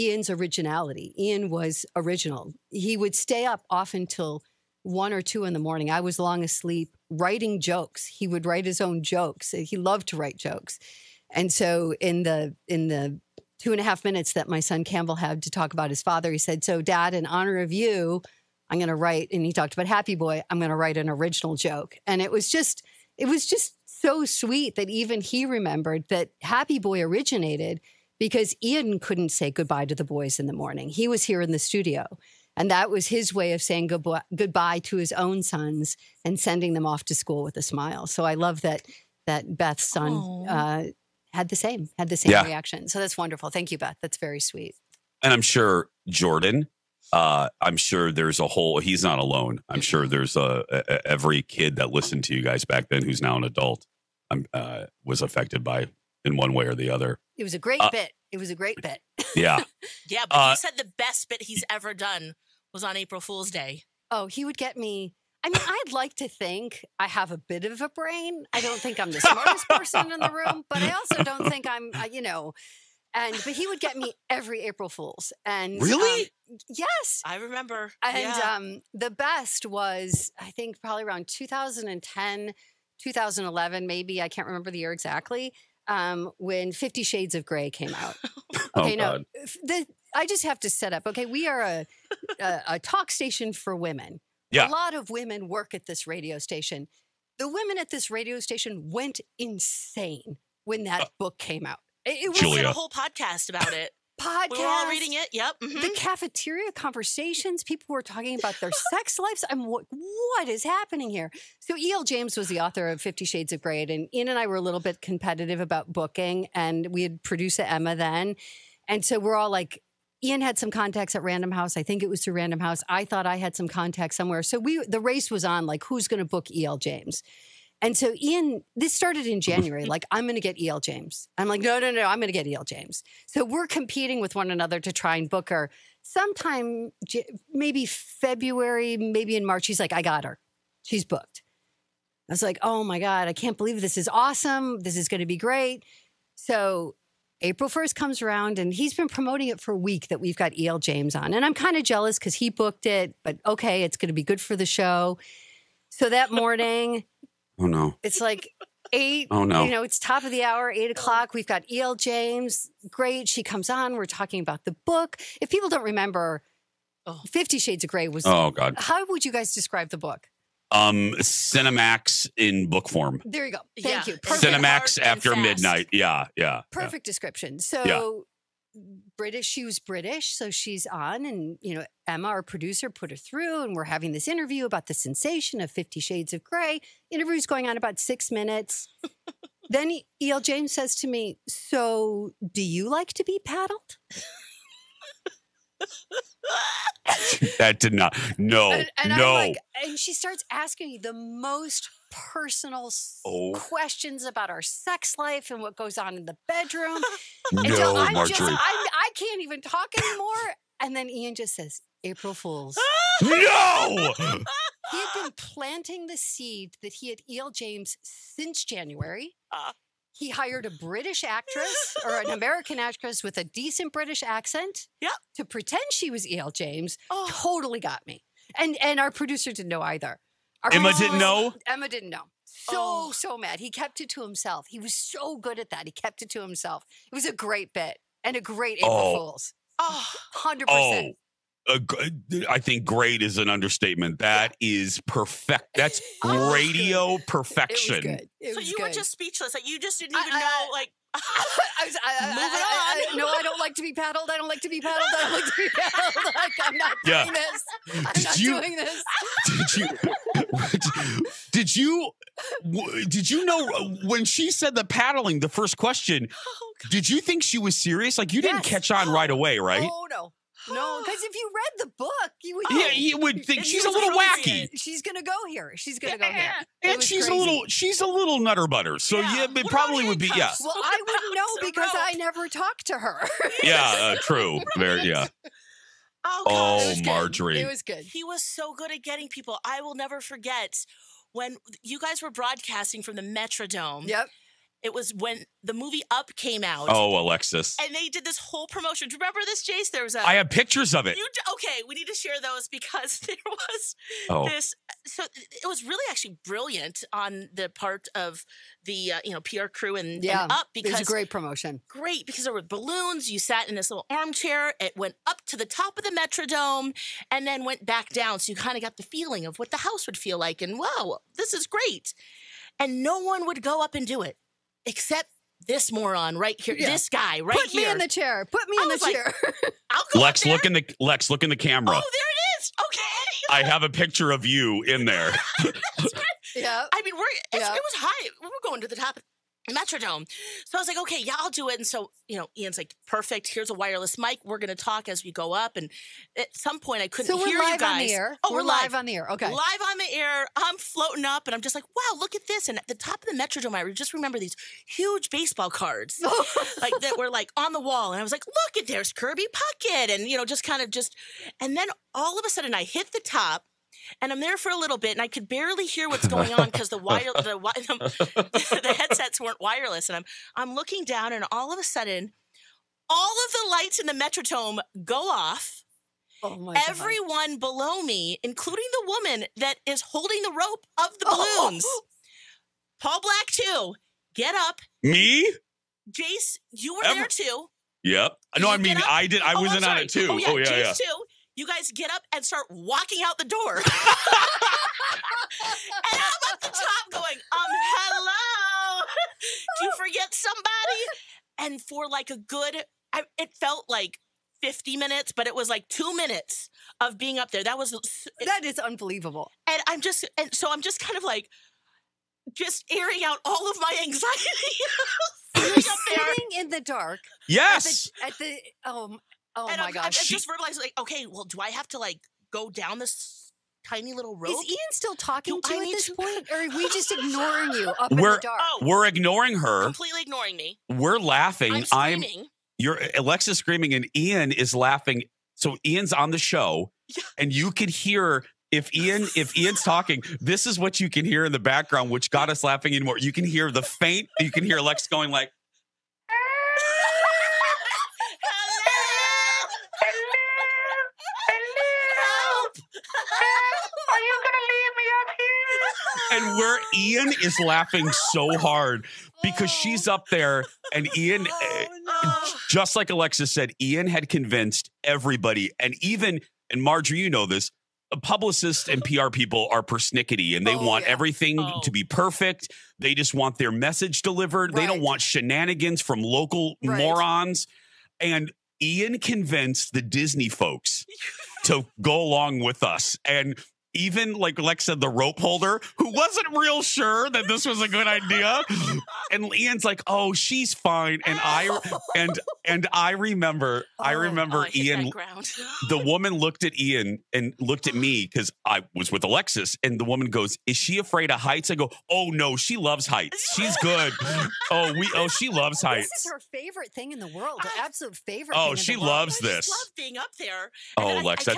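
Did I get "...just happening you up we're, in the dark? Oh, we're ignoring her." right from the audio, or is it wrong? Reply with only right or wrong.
wrong.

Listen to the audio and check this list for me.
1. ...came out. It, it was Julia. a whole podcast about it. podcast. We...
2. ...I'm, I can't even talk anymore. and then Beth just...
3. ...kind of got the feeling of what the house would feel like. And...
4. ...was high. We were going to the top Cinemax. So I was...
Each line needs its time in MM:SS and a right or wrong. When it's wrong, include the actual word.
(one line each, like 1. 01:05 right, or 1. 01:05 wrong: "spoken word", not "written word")
1. 01:41 right
2. 03:28 wrong: "Ian", not "Beth"
3. 05:18 right
4. 05:37 wrong: "Metrodome", not "Cinemax".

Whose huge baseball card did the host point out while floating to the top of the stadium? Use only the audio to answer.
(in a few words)
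Kirby Puckett.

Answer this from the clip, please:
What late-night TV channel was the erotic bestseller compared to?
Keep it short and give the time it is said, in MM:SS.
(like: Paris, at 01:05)
Cinemax in book form, at 02:51.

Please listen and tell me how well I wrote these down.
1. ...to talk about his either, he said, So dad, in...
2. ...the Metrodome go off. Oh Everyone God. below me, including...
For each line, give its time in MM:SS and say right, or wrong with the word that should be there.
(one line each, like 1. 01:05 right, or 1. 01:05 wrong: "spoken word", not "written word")
1. 00:15 wrong: "father", not "either"
2. 06:14 right.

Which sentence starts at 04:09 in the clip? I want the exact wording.
Like you just didn't even I, I, know.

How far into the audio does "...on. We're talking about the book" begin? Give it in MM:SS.
02:43.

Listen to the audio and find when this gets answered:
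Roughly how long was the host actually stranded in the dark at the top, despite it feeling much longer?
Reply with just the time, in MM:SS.
06:45.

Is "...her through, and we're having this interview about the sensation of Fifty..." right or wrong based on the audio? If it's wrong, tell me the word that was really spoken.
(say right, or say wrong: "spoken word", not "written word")
right.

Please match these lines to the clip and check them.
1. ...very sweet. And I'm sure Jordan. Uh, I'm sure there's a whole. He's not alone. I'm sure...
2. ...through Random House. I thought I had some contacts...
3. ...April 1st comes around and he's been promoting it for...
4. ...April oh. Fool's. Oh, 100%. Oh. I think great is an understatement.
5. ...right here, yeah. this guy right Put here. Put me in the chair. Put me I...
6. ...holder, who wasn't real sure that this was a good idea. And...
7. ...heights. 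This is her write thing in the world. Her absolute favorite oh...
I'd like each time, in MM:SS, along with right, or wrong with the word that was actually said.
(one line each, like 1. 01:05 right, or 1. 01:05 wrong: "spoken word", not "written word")
1. 00:44 right
2. 02:02 right
3. 02:27 right
4. 03:58 right
5. 05:26 right
6. 08:05 right
7. 08:25 wrong: "favorite", not "write".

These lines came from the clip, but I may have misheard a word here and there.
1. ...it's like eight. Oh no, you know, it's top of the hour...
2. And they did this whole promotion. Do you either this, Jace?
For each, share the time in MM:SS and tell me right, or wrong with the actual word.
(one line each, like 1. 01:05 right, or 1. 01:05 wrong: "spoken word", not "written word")
1. 02:38 right
2. 04:57 wrong: "remember", not "either".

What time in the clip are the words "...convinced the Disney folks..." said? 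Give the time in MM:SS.
07:59.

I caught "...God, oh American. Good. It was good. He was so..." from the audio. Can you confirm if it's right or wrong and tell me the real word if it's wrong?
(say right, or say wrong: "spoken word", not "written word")
wrong: "Margery", not "American".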